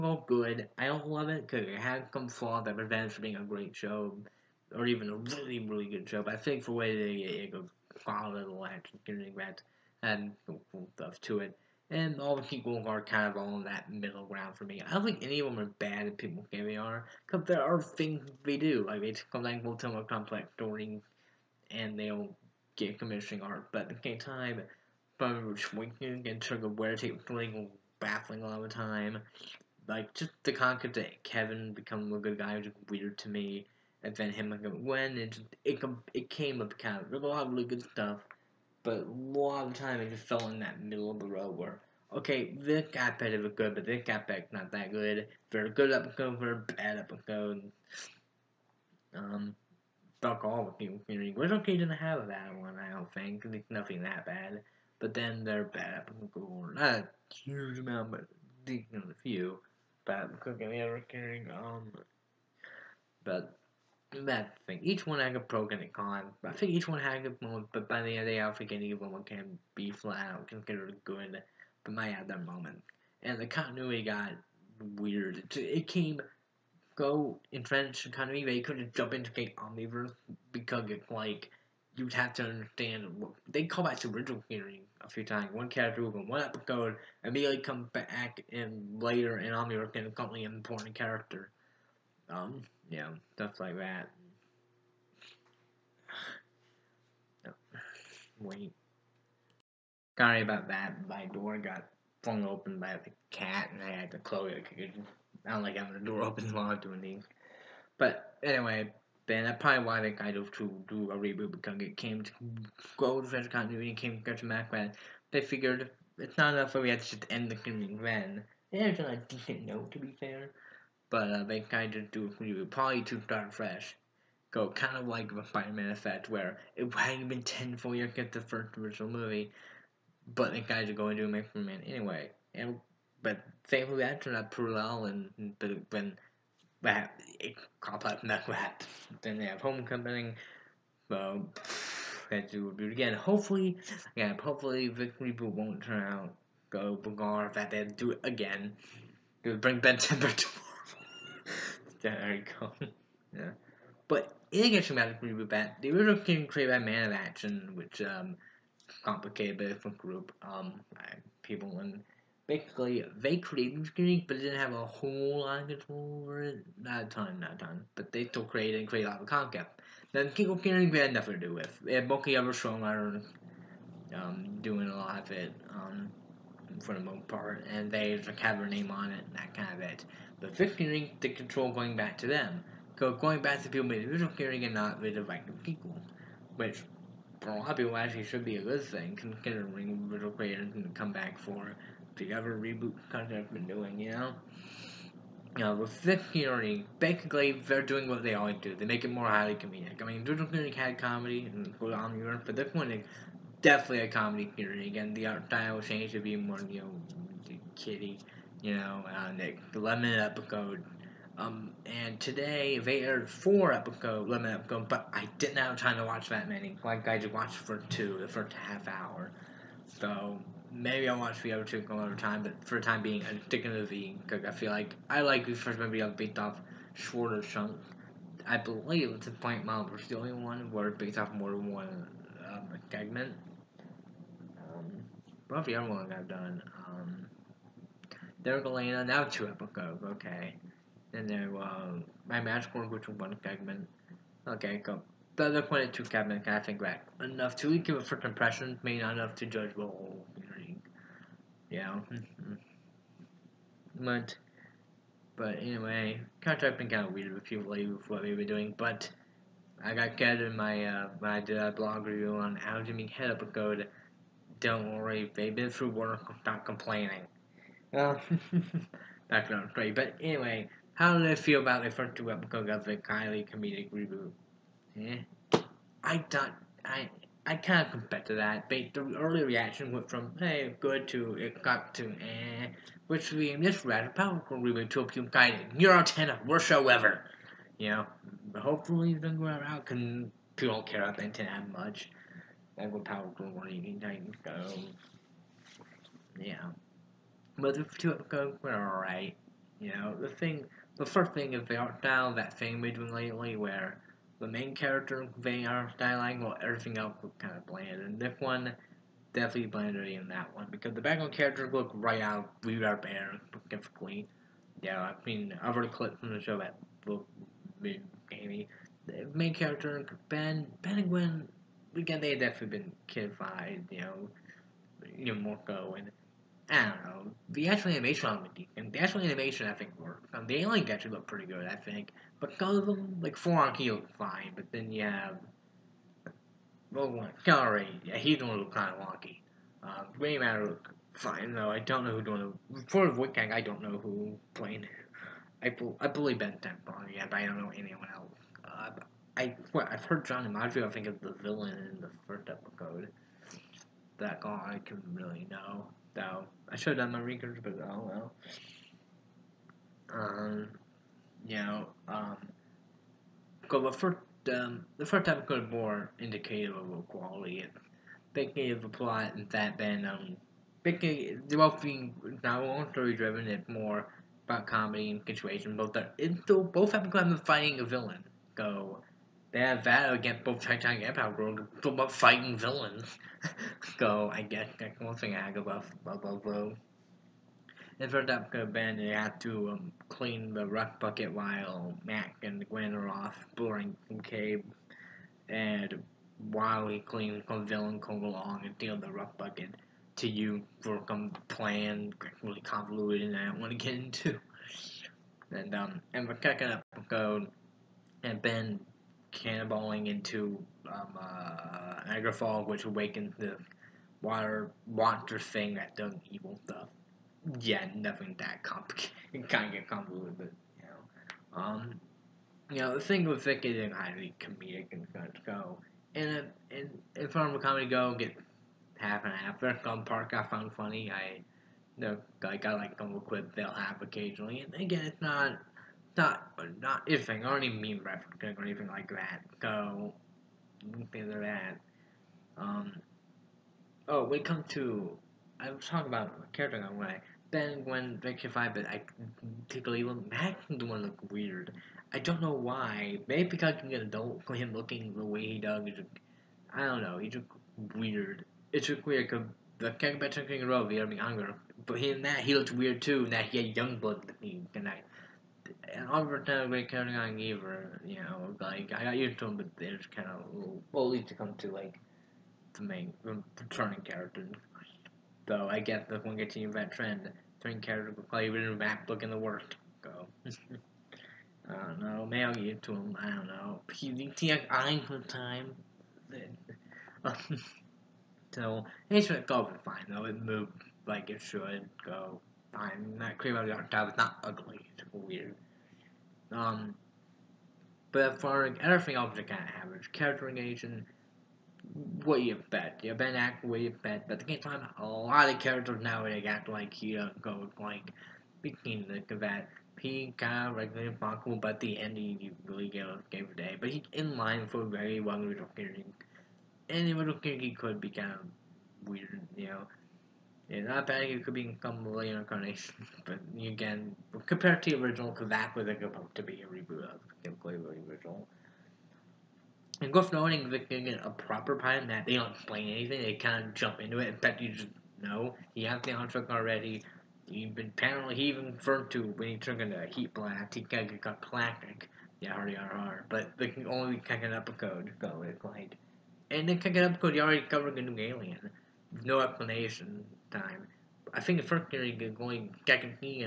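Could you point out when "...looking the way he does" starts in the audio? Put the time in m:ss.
7:34.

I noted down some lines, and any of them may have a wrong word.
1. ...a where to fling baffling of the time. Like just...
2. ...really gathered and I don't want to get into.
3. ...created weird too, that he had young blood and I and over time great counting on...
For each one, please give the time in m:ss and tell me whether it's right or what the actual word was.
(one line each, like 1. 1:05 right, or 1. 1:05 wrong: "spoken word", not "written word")
1. 0:26 right
2. 6:42 wrong: "convoluted", not "gathered"
3. 7:42 wrong: "looked", not "created".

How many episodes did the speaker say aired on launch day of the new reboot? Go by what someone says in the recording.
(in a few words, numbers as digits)
4.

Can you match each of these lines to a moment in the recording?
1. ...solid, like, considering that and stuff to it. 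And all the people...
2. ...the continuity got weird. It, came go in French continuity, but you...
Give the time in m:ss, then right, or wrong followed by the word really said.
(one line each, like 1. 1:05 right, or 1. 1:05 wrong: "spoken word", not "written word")
1. 0:08 right
2. 1:13 right.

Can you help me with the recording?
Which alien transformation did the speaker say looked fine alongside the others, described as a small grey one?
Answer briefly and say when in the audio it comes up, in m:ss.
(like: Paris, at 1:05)
Gray Matter, at 5:40.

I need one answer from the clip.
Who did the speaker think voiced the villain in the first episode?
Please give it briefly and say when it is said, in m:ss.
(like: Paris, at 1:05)
John DiMaggio, at 5:50.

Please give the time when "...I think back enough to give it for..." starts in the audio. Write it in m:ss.
4:06.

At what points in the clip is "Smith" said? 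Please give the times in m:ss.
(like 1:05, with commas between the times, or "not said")
not said.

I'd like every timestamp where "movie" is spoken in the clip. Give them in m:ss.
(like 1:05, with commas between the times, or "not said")
2:09, 3:45.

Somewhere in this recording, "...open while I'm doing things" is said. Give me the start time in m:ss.
1:46.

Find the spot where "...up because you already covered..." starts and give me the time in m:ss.
9:06.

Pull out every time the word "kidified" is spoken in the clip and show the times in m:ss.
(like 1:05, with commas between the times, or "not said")
5:23.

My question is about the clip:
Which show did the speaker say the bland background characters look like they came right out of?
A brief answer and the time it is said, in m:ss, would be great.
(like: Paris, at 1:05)
We Are Bear, at 5:12.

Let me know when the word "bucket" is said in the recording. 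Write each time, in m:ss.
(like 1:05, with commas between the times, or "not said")
6:31, 6:39.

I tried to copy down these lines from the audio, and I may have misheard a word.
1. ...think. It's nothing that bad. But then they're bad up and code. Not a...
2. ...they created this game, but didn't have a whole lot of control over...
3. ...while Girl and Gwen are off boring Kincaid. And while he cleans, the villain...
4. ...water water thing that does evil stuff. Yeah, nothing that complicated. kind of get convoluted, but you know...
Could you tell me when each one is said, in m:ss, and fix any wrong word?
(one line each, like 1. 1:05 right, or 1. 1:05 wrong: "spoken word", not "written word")
1. 0:53 right
2. 2:43 right
3. 6:31 wrong: "Mac", not "Girl"
4. 6:54 right.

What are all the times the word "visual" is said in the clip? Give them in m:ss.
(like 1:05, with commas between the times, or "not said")
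3:04, 3:10, 3:20.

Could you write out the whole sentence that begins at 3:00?
But fifth Ring, the control going back to them.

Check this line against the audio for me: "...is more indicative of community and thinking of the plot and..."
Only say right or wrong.
wrong.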